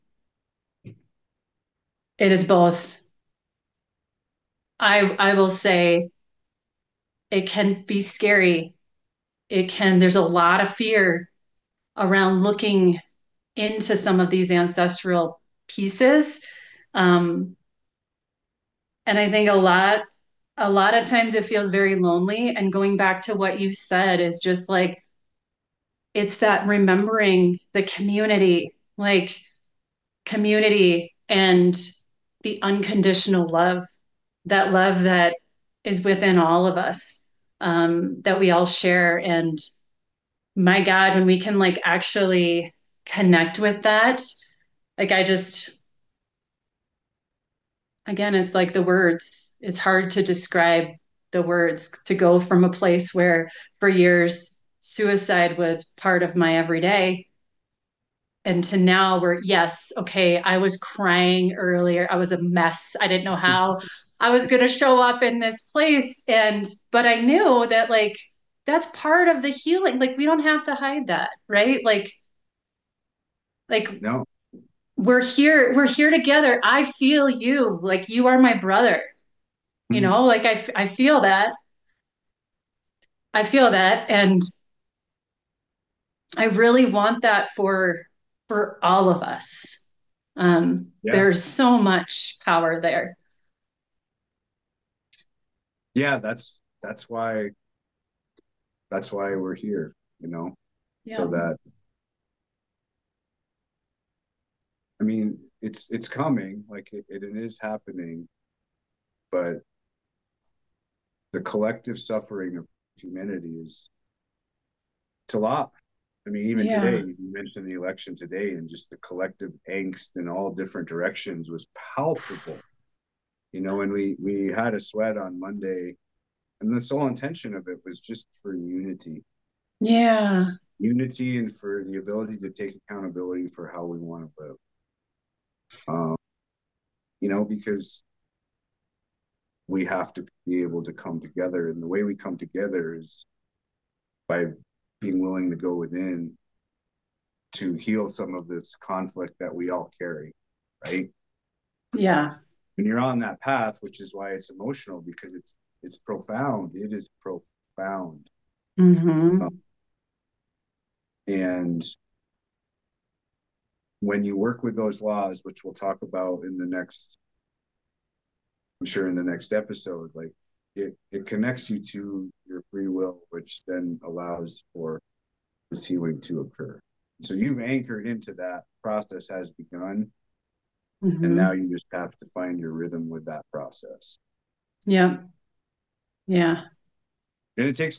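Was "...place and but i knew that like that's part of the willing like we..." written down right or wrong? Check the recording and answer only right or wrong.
wrong.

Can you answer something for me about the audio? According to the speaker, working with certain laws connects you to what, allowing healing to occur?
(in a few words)
Free will.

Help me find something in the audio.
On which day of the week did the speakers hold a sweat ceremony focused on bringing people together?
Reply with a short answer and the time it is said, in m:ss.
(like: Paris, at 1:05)
Monday, at 2:05.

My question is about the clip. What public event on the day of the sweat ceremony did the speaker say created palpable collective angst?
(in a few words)
The election.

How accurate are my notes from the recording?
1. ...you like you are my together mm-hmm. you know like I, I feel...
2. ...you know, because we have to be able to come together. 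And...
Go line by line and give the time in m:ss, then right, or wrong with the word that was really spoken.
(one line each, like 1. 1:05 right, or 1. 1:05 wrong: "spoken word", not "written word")
1. 1:17 wrong: "brother", not "together"
2. 2:17 right.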